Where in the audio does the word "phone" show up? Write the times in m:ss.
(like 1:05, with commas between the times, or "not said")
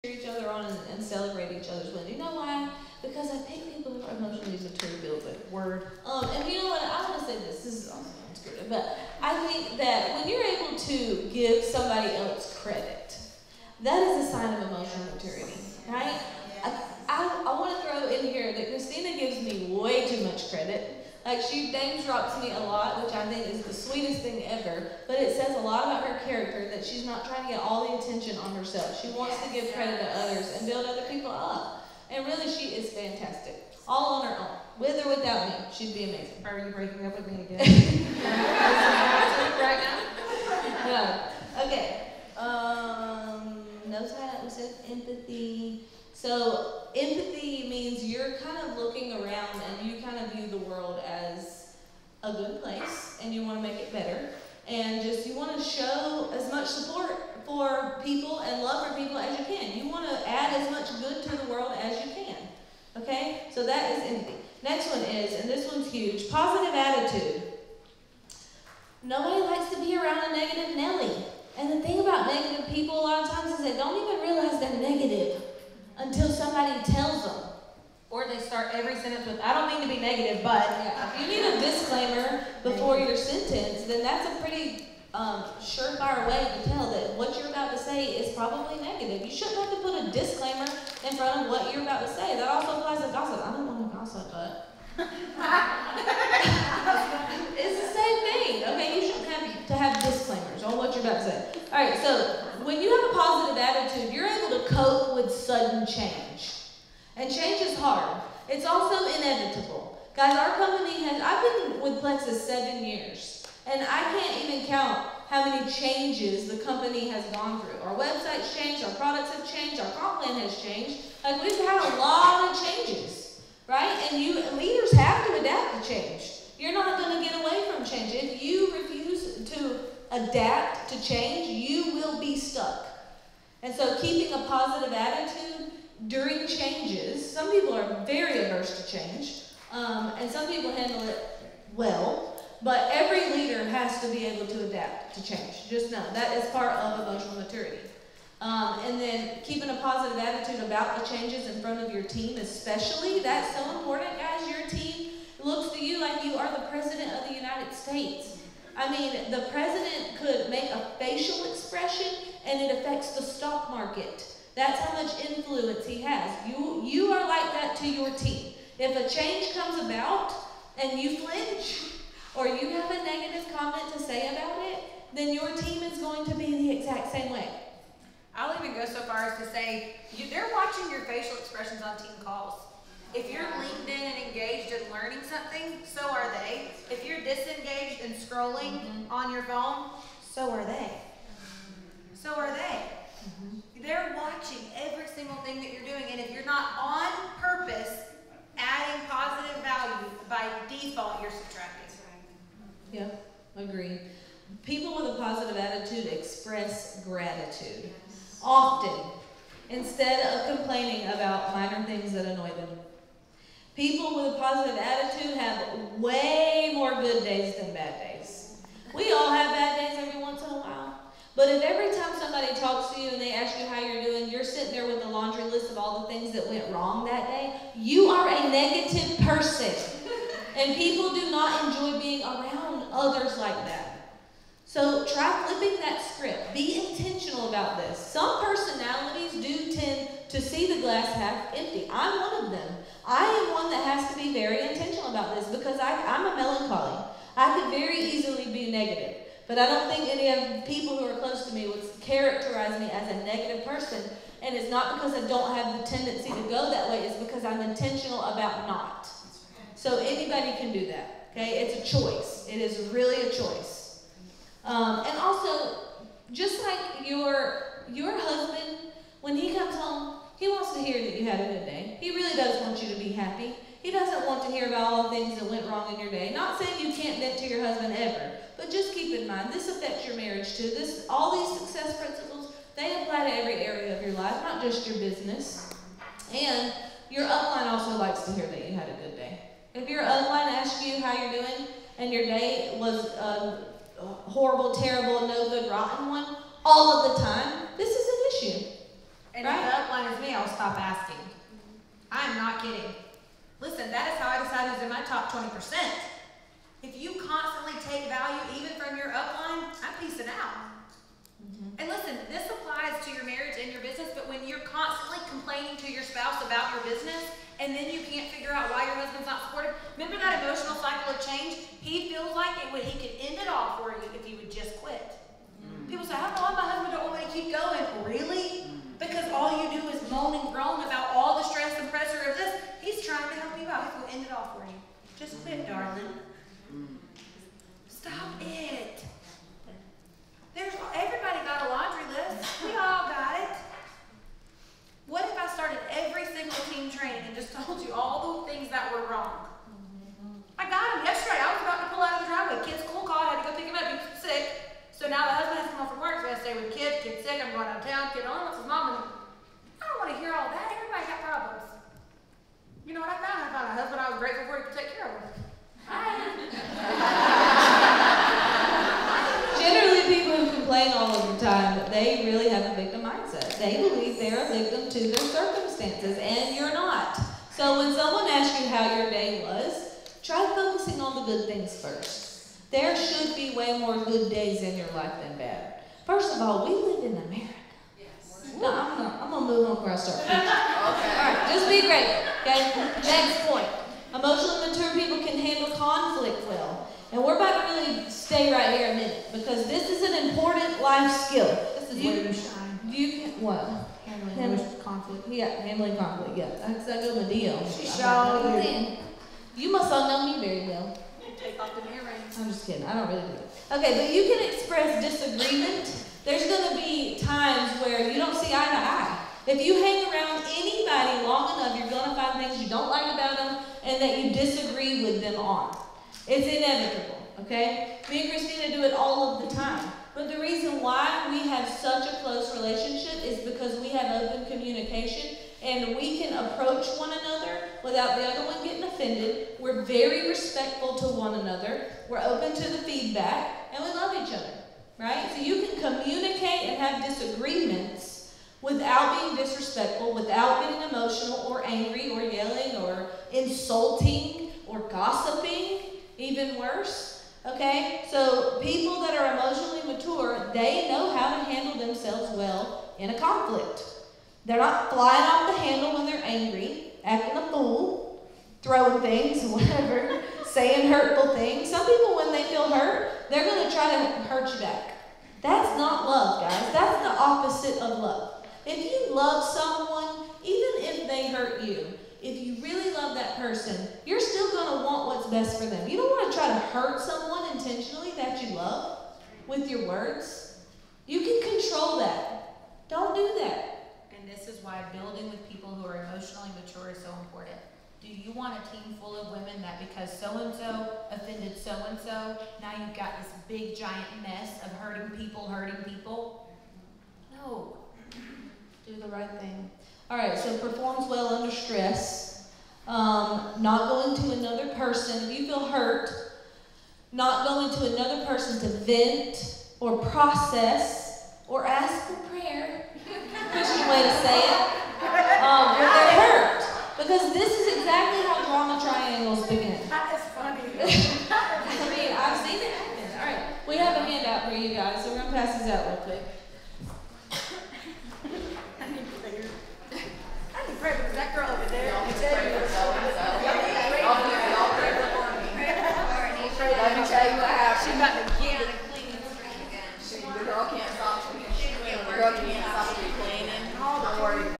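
3:09.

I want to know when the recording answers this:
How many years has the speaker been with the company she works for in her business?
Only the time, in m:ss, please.
1:52.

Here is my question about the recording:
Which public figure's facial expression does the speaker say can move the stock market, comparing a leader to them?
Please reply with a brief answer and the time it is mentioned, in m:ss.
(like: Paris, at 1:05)
The president of the United States, at 2:36.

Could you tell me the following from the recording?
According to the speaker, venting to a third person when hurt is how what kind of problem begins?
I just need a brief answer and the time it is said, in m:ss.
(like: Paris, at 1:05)
Drama triangles, at 8:48.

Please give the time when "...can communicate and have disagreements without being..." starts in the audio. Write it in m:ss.
7:25.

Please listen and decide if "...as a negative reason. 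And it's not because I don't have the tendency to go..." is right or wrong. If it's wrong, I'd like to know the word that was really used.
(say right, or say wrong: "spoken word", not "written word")
wrong: "person", not "reason".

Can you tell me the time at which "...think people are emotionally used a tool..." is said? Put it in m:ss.
0:03.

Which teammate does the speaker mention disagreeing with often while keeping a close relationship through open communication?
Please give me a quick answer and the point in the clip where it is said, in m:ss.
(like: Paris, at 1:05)
Christina, at 7:08.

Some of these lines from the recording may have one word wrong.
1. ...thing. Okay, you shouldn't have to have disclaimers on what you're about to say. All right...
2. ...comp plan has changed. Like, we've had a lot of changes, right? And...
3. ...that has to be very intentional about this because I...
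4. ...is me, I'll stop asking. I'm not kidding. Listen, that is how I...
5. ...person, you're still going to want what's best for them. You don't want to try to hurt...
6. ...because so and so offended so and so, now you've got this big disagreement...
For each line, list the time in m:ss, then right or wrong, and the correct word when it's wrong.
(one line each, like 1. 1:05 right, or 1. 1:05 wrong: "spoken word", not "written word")
1. 1:38 right
2. 1:59 right
3. 4:03 right
4. 5:00 right
5. 8:03 right
6. 8:19 wrong: "giant", not "disagreement".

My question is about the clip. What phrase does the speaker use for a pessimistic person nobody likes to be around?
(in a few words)
Negative Nelly.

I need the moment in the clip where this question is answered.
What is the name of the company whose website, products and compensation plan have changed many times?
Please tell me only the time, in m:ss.
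1:51.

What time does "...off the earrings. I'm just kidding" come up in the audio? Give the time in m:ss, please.
6:51.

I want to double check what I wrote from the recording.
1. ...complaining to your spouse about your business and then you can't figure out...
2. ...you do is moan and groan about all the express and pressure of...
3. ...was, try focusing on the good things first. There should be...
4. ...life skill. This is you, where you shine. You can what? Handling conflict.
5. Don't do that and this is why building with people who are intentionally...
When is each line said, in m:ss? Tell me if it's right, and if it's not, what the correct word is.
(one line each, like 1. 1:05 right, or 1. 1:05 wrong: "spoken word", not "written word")
1. 5:15 right
2. 5:29 wrong: "stress", not "express"
3. 6:19 right
4. 6:40 right
5. 8:12 wrong: "emotionally", not "intentionally".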